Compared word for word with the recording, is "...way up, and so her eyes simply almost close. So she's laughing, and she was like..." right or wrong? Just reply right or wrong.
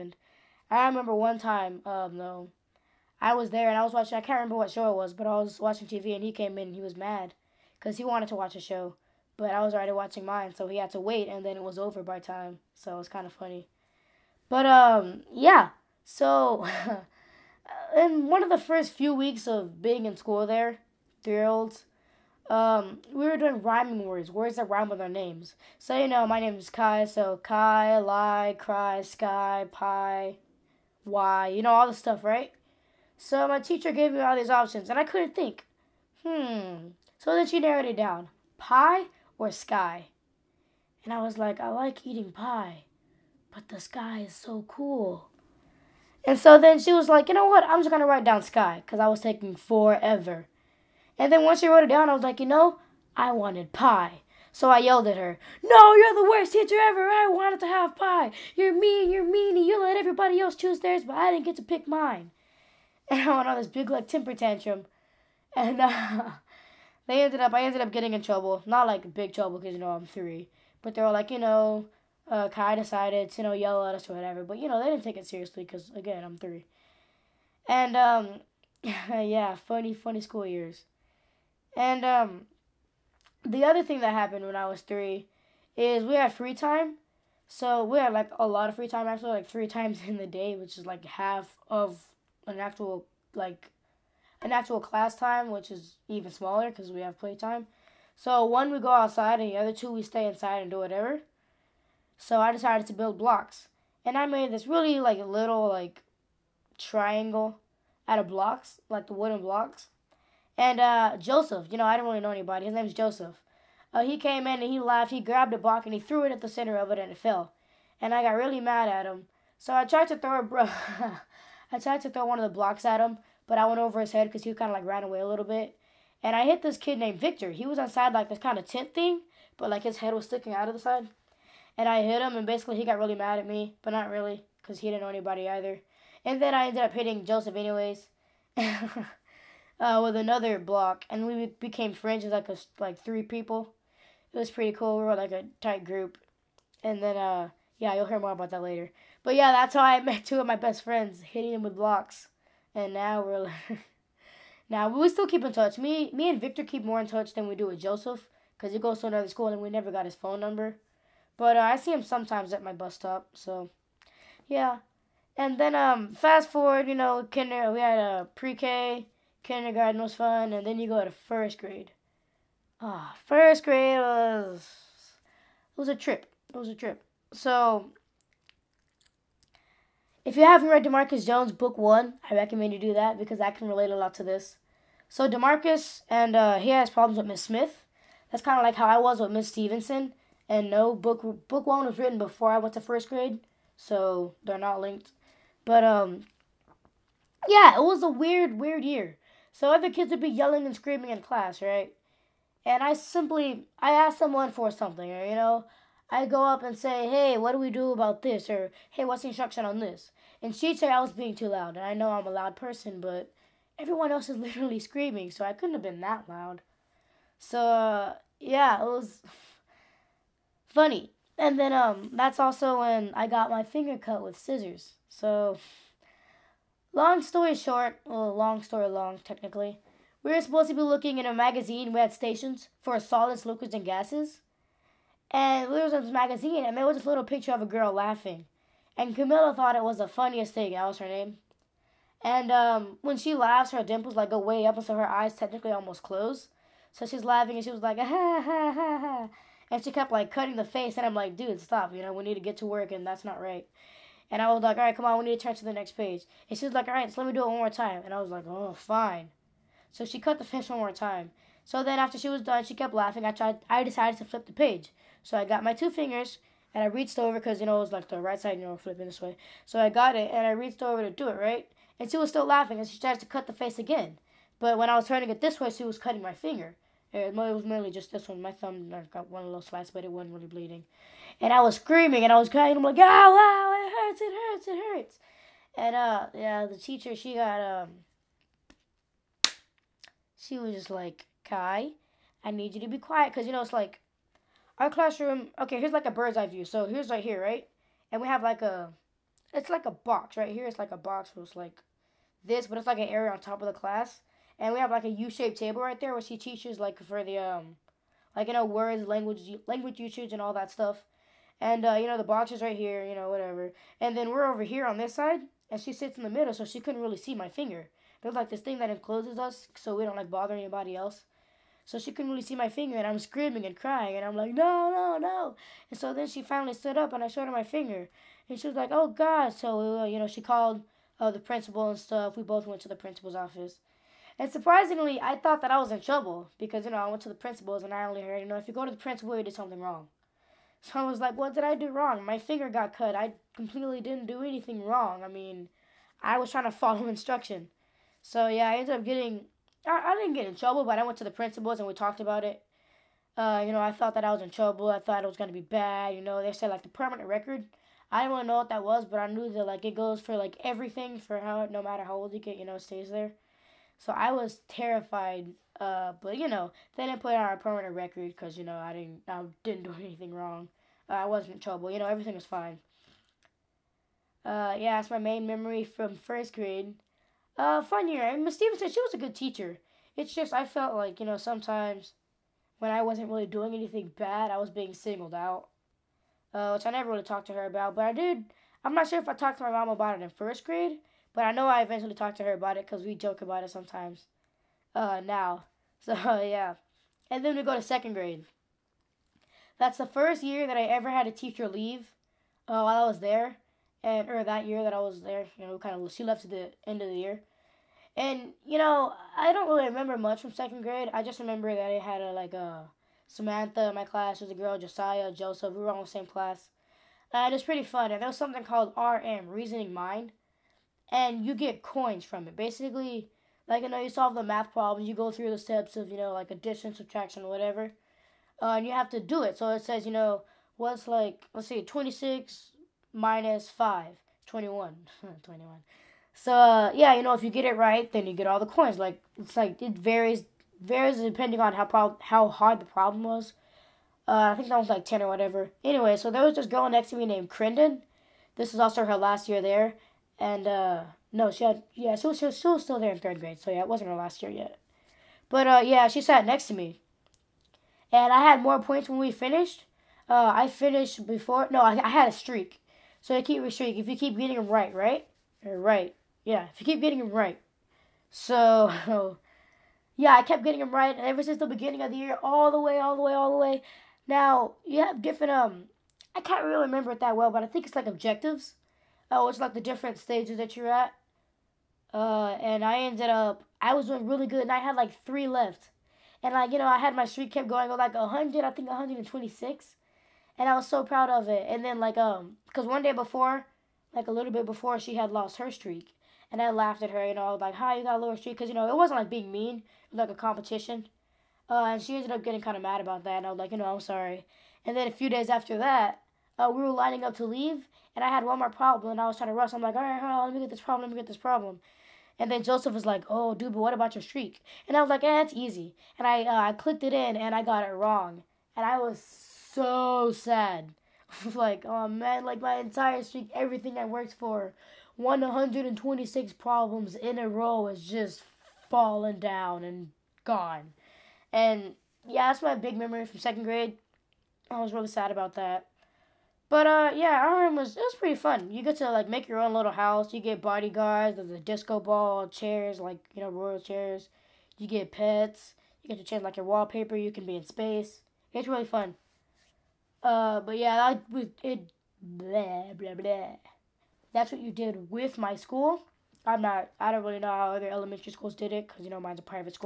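wrong.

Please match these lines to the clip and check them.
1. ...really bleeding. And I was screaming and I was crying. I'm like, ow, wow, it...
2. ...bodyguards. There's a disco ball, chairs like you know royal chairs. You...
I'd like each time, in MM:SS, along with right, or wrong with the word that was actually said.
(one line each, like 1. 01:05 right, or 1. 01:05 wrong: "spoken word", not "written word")
1. 04:40 right
2. 09:00 right.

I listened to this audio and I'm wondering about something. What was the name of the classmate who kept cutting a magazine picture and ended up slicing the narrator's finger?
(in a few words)
Camilla.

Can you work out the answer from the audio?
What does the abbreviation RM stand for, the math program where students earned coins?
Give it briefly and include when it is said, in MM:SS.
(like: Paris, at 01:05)
Reasoning Mind, at 06:59.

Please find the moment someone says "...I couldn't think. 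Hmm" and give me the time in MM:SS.
00:34.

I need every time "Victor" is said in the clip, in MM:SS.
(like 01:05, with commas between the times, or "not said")
02:07, 02:36.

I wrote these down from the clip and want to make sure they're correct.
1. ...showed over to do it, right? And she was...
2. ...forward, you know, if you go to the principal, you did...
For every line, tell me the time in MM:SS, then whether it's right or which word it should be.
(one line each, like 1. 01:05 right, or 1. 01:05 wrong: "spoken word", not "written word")
1. 04:30 wrong: "reached", not "showed"
2. 05:38 wrong: "heard", not "forward".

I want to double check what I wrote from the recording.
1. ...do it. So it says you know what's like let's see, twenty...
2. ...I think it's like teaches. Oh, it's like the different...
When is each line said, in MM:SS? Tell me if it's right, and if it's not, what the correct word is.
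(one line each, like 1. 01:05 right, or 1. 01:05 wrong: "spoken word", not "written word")
1. 07:09 right
2. 07:57 wrong: "objectives", not "teaches".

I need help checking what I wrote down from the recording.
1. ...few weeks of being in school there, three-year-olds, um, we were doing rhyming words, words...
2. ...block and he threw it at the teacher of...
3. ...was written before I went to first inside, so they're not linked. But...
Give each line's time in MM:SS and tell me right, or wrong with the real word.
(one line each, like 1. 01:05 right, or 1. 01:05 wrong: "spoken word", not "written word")
1. 00:18 right
2. 01:55 wrong: "center", not "teacher"
3. 03:11 wrong: "grade", not "inside".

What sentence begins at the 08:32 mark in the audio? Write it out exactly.
And then Joseph was like, oh, dude, but what about your streak?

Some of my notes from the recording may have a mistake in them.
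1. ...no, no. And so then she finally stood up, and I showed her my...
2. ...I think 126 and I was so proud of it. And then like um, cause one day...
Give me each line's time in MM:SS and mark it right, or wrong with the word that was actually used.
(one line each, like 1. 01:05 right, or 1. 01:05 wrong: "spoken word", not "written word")
1. 05:24 right
2. 08:08 right.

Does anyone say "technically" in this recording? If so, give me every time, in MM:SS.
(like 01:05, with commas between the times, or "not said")
03:49, 04:05.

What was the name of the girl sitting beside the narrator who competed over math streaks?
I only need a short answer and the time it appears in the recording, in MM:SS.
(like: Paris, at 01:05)
Crendon, at 07:27.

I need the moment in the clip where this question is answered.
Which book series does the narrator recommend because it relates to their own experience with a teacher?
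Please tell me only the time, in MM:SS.
03:00.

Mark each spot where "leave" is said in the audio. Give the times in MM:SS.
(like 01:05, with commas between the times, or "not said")
06:41, 08:27.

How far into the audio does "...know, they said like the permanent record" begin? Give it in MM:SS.
05:56.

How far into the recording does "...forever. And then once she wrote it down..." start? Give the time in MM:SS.
00:49.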